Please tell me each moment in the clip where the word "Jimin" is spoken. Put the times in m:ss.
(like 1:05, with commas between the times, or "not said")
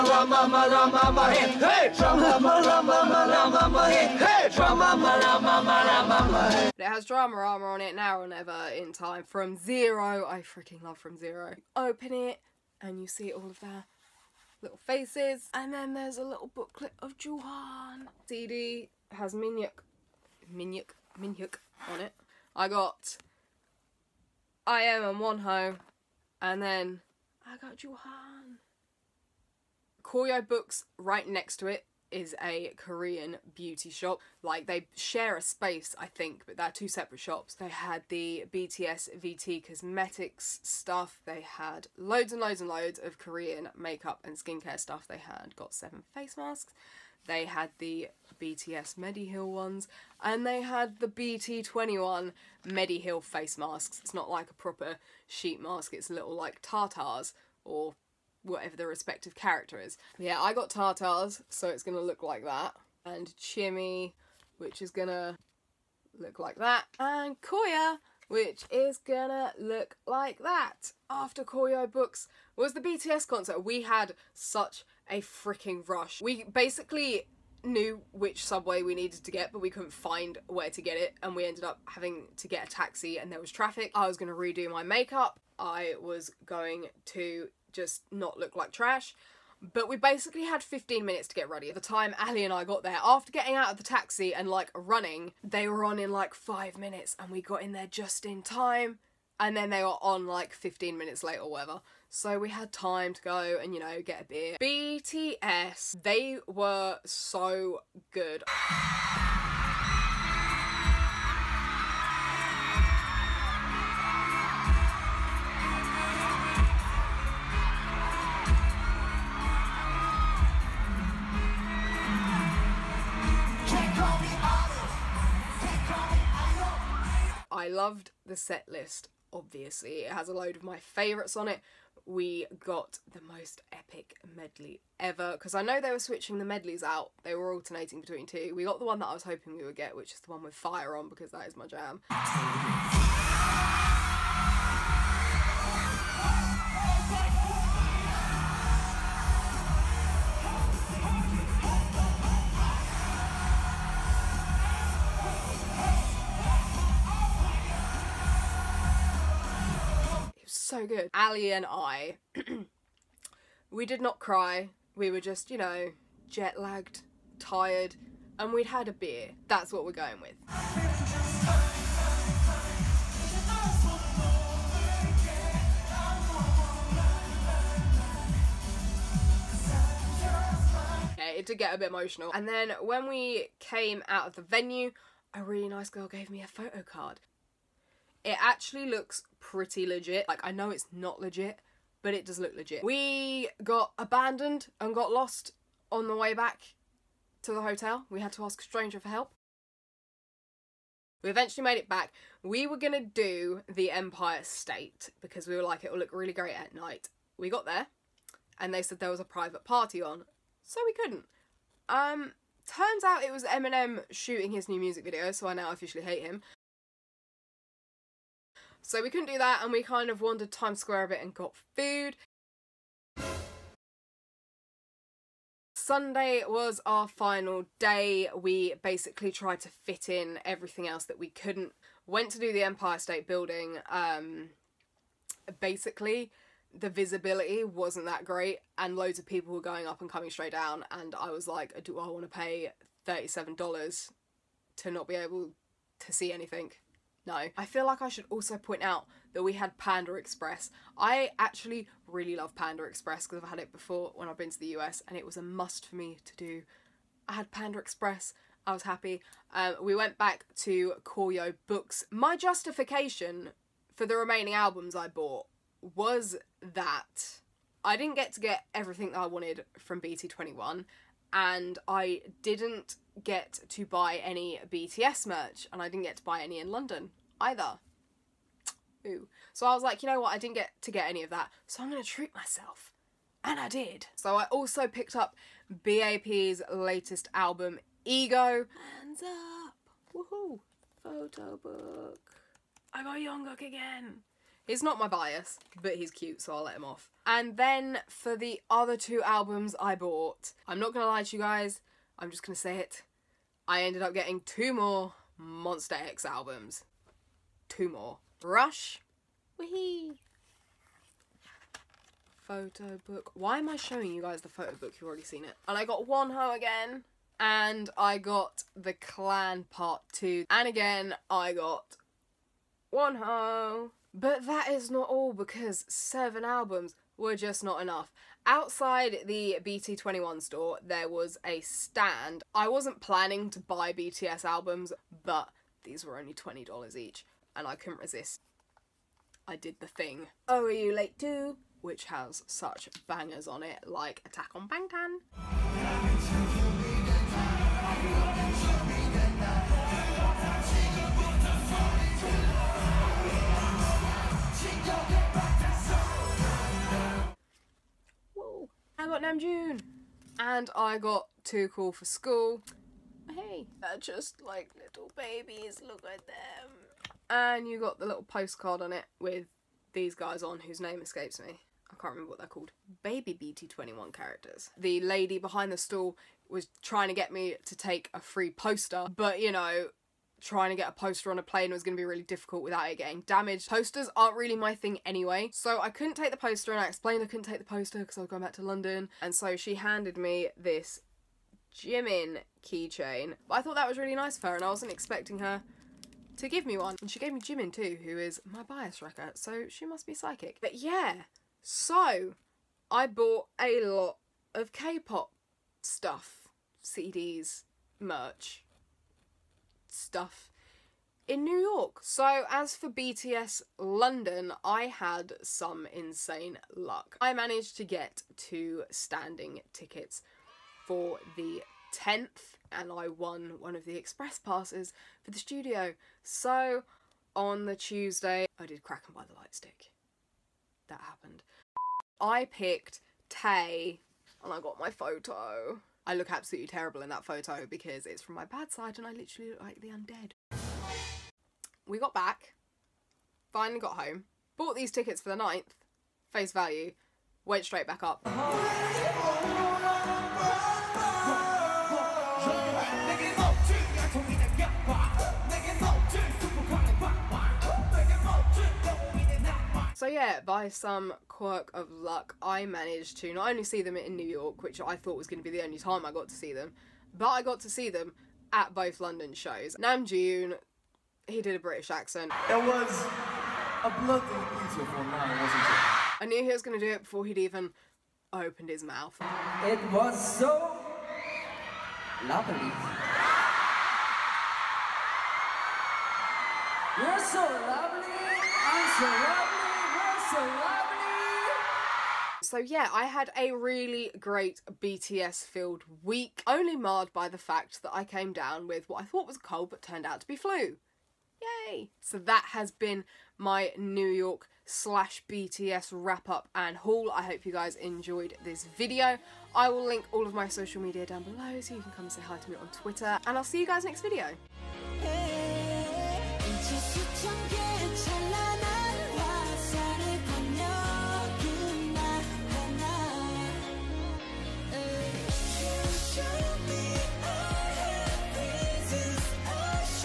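6:31, 6:37.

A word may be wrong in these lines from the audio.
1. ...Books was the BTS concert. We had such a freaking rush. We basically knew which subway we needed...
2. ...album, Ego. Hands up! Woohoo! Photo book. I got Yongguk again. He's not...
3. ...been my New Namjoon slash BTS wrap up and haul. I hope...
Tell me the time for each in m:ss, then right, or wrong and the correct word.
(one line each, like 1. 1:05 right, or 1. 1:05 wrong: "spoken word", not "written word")
1. 1:11 right
2. 4:47 right
3. 8:22 wrong: "York", not "Namjoon".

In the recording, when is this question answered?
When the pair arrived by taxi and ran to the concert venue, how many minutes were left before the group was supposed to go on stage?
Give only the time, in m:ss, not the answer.
1:36.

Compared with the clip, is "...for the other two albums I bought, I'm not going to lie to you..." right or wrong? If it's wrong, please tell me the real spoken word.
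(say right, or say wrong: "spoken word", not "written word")
right.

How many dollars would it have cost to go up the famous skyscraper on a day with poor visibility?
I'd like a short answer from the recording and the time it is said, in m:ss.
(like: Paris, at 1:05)
$37, at 4:03.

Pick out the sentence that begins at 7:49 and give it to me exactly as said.
Namjoon, he did a British accent.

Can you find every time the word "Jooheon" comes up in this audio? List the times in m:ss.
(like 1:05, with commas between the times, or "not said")
0:17, 0:27.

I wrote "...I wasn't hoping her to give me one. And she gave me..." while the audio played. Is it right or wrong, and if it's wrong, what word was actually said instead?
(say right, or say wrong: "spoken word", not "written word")
wrong: "expecting", not "hoping".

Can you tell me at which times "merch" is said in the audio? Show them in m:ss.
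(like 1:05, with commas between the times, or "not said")
4:35, 6:48.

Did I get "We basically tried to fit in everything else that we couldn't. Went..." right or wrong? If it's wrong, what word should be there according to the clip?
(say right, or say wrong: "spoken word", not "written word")
right.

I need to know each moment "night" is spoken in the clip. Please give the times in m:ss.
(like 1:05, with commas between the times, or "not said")
3:26, 7:55.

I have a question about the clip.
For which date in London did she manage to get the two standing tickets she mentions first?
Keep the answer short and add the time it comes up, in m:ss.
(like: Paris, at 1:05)
the 10th, at 7:01.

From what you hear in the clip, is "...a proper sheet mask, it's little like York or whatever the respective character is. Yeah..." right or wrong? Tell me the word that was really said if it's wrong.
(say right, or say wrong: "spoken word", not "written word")
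wrong: "Tatas", not "York".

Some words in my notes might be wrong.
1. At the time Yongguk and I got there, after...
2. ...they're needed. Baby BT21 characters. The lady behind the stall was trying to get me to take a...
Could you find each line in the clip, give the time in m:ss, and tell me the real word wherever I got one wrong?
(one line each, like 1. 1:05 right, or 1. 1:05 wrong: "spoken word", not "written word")
1. 1:31 wrong: "Ali", not "Yongguk"
2. 6:12 wrong: "called", not "needed".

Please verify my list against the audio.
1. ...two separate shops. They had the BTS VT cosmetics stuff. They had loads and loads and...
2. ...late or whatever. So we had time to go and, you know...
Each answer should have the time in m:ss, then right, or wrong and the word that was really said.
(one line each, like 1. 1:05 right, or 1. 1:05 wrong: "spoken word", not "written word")
1. 0:36 right
2. 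1:41 right.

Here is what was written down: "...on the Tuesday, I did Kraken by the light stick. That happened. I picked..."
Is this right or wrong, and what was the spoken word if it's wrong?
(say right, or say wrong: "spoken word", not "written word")
right.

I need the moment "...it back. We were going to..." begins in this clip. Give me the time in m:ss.
3:21.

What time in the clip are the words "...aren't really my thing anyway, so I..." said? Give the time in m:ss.
6:24.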